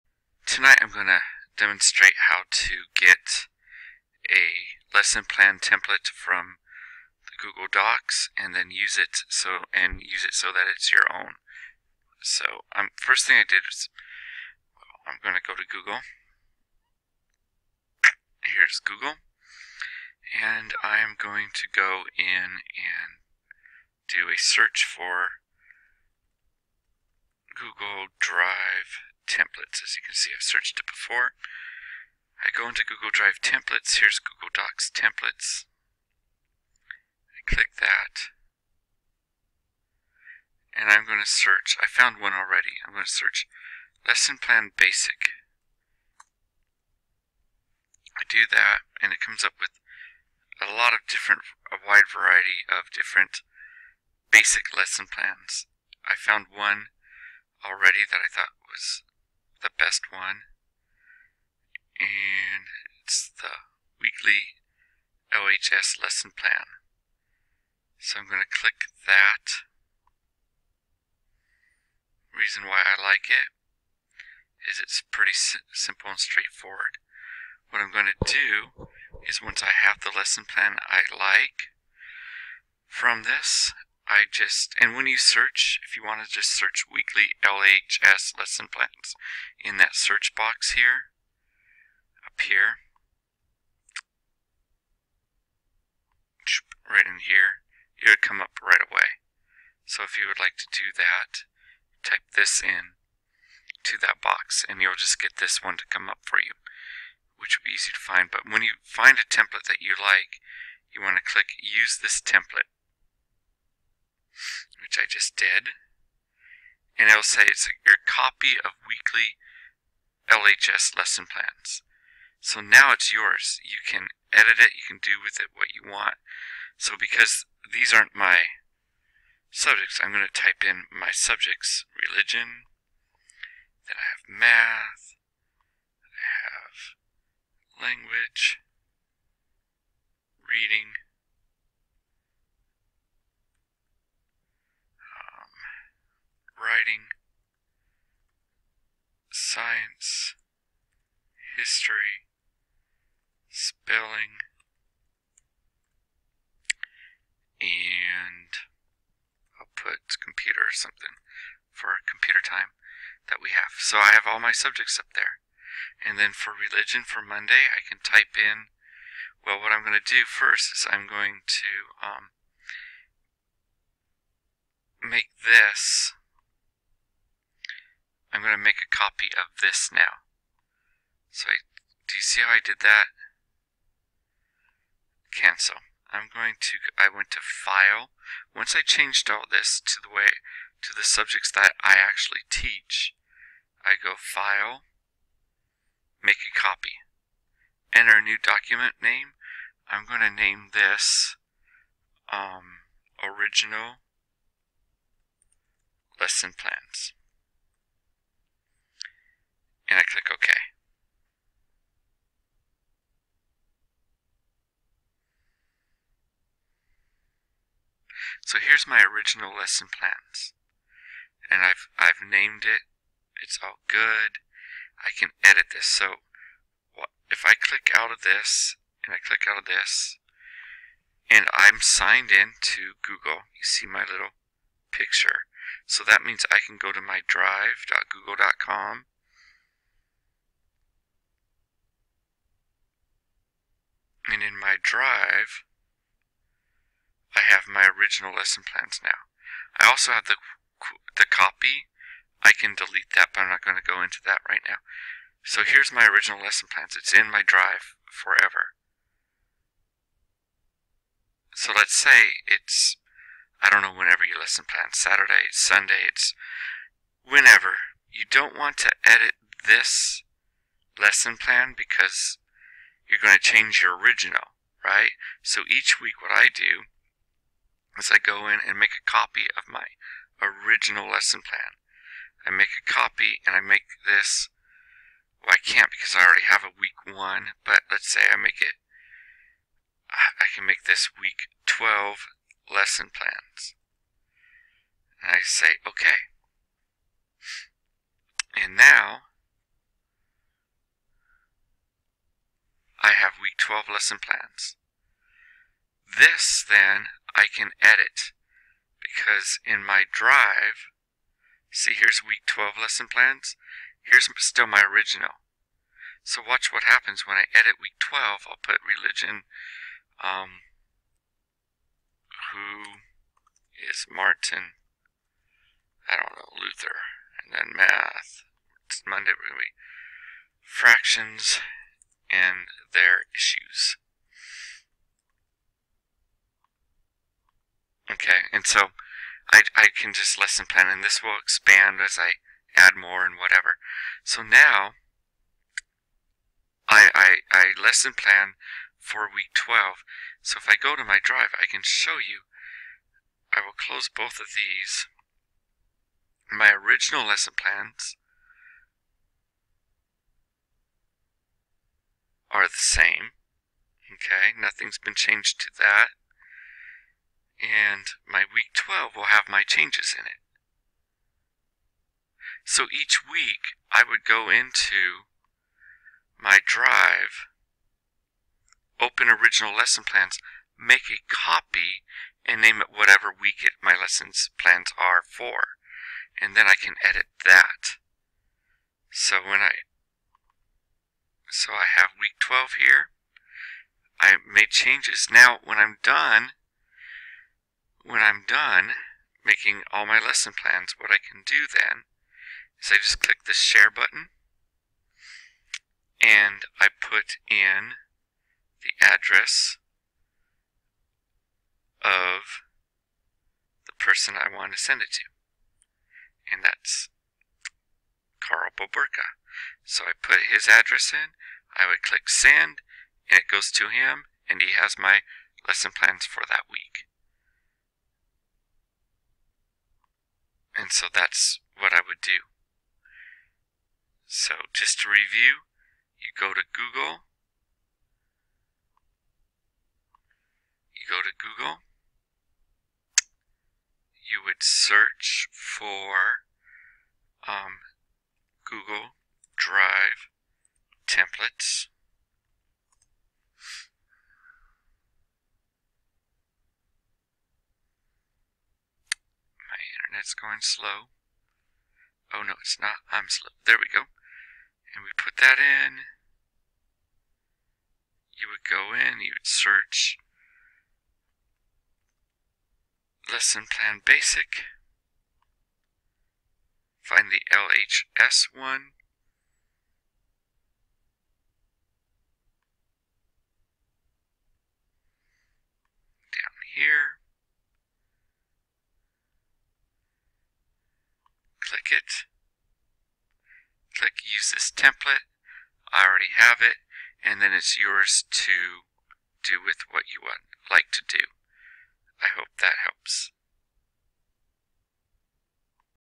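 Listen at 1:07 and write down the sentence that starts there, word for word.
So I'm going to click that.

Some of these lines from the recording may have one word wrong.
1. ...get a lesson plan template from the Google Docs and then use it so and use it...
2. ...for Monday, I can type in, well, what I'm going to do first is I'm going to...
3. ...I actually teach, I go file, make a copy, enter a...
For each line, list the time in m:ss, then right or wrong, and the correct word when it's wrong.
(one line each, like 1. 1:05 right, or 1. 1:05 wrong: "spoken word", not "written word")
1. 0:02 right
2. 2:47 right
3. 3:11 right.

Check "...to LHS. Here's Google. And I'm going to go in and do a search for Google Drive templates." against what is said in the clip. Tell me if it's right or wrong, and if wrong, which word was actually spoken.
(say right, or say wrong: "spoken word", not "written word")
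wrong: "Google", not "LHS".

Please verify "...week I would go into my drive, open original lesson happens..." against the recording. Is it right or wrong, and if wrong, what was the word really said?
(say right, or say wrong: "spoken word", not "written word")
wrong: "plans", not "happens".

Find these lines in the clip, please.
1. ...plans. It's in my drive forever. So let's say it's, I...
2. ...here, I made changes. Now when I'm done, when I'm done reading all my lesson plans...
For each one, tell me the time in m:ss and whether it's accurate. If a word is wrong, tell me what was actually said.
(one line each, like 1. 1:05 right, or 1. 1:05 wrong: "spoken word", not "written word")
1. 4:16 right
2. 6:32 wrong: "making", not "reading".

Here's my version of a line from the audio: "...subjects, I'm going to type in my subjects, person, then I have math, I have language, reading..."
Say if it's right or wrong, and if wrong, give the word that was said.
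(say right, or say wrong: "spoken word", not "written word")
wrong: "religion", not "person".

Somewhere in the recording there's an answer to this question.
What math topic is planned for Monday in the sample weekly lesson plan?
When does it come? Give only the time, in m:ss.
5:30.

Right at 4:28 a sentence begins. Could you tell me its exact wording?
You don't want to edit this lesson plan because you're going to change your original, right?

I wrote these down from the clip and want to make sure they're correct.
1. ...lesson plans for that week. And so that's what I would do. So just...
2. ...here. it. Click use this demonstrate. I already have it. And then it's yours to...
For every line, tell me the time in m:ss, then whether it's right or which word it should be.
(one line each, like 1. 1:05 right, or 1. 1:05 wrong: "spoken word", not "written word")
1. 7:05 right
2. 8:06 wrong: "template", not "demonstrate".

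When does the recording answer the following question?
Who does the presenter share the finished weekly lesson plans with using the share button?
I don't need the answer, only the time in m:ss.
6:58.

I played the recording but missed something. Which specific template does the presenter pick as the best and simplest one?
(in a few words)
weekly LHS lesson plan.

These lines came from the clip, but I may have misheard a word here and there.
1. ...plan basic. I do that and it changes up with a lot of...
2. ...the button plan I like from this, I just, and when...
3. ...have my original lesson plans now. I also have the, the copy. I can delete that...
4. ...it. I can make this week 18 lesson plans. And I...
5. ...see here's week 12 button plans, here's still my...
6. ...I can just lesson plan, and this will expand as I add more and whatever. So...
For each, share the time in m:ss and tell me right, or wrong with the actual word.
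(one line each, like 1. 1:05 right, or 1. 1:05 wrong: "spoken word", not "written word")
1. 0:44 wrong: "comes", not "changes"
2. 1:20 wrong: "lesson", not "button"
3. 4:07 right
4. 4:48 wrong: "12", not "18"
5. 5:11 wrong: "lesson", not "button"
6. 5:39 right.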